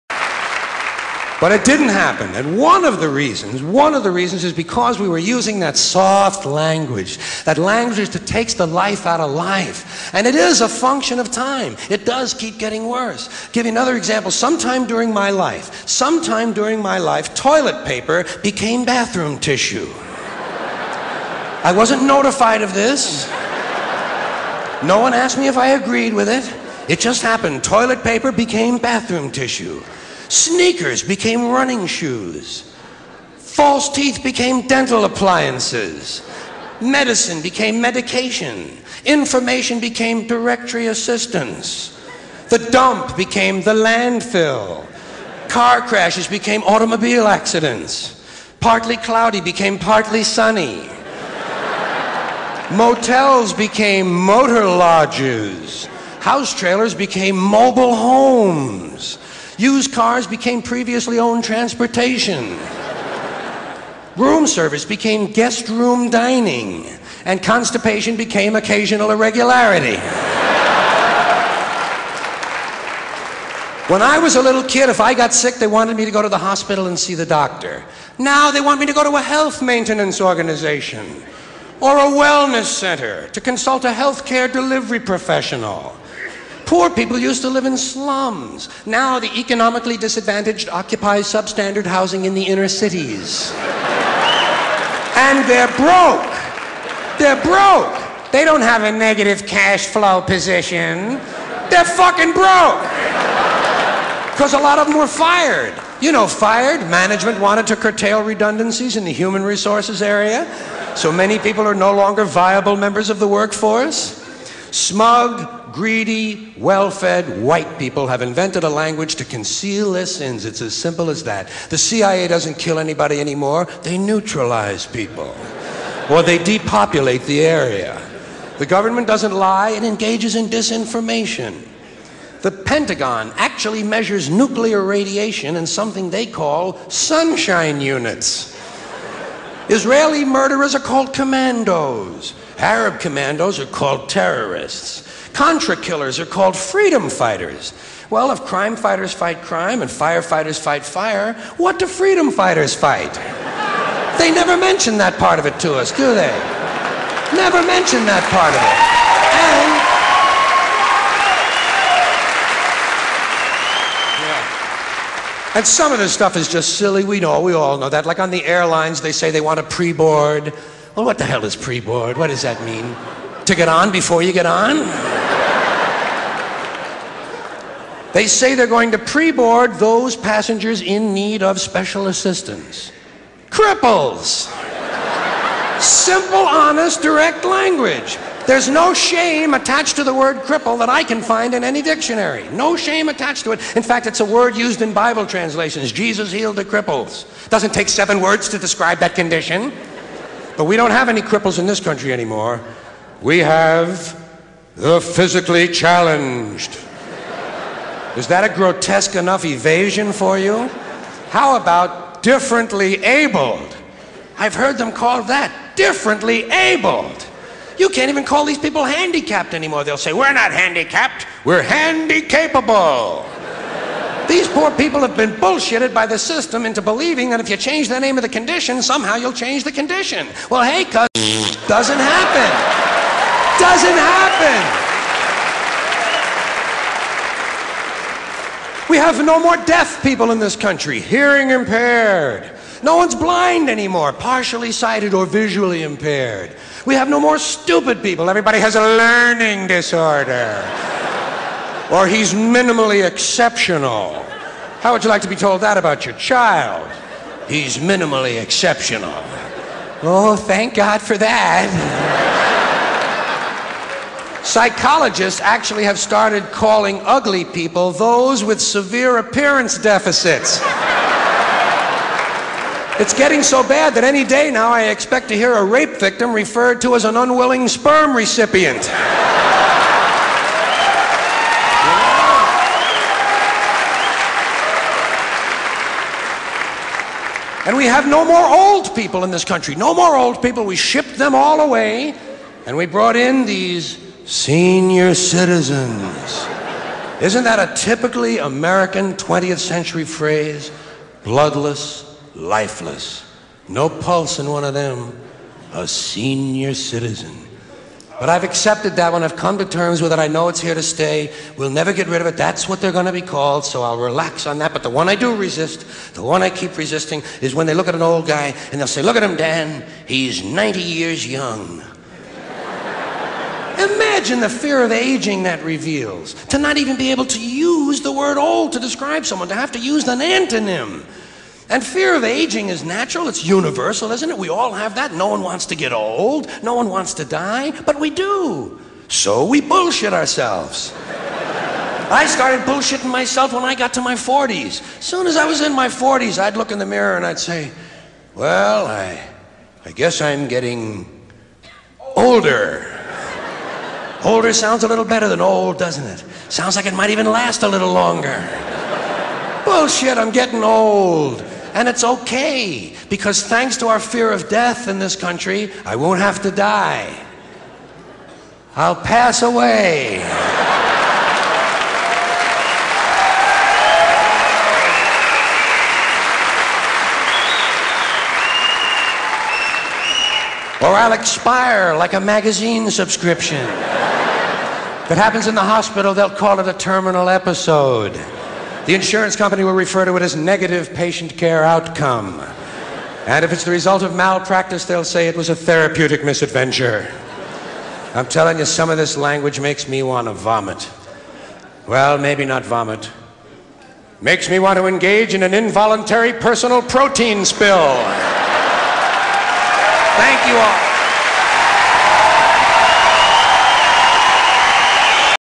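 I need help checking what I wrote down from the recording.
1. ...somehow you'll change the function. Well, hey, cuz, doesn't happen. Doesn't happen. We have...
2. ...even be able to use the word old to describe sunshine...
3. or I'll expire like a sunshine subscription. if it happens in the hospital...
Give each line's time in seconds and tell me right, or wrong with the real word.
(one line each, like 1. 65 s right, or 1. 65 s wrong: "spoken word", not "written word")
1. 228 s wrong: "condition", not "function"
2. 326 s wrong: "someone", not "sunshine"
3. 380 s wrong: "magazine", not "sunshine".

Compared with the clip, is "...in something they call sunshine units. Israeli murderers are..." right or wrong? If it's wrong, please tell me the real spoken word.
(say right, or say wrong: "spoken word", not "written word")
right.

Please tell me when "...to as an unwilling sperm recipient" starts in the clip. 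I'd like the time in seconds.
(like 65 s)
276 s.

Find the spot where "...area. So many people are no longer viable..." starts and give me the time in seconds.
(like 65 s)
110 s.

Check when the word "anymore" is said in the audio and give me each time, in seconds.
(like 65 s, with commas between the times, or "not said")
123 s, 202 s, 219 s, 243 s.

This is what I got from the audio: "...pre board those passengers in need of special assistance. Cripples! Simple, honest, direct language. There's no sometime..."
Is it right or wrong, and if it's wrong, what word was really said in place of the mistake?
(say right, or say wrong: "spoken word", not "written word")
wrong: "shame", not "sometime".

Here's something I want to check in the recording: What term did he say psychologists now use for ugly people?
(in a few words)
severe appearance deficits.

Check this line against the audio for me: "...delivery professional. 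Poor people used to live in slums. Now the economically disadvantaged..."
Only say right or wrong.
right.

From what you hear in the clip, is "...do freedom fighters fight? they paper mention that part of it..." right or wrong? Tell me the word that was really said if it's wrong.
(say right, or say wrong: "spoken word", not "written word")
wrong: "never", not "paper".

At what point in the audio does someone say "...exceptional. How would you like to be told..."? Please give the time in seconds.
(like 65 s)
253 s.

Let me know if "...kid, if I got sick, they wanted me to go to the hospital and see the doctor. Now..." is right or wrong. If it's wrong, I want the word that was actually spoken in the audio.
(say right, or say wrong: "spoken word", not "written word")
right.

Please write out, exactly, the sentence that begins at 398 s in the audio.
I'm telling you, some of this language makes me want to vomit.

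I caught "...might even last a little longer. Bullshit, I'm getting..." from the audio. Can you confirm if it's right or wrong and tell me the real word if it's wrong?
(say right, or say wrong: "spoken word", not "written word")
right.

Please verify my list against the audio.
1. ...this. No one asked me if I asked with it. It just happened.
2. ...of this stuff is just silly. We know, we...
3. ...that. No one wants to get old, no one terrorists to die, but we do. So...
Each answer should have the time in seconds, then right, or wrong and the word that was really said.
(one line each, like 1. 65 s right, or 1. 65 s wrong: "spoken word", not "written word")
1. 22 s wrong: "agreed", not "asked"
2. 165 s right
3. 334 s wrong: "wants", not "terrorists".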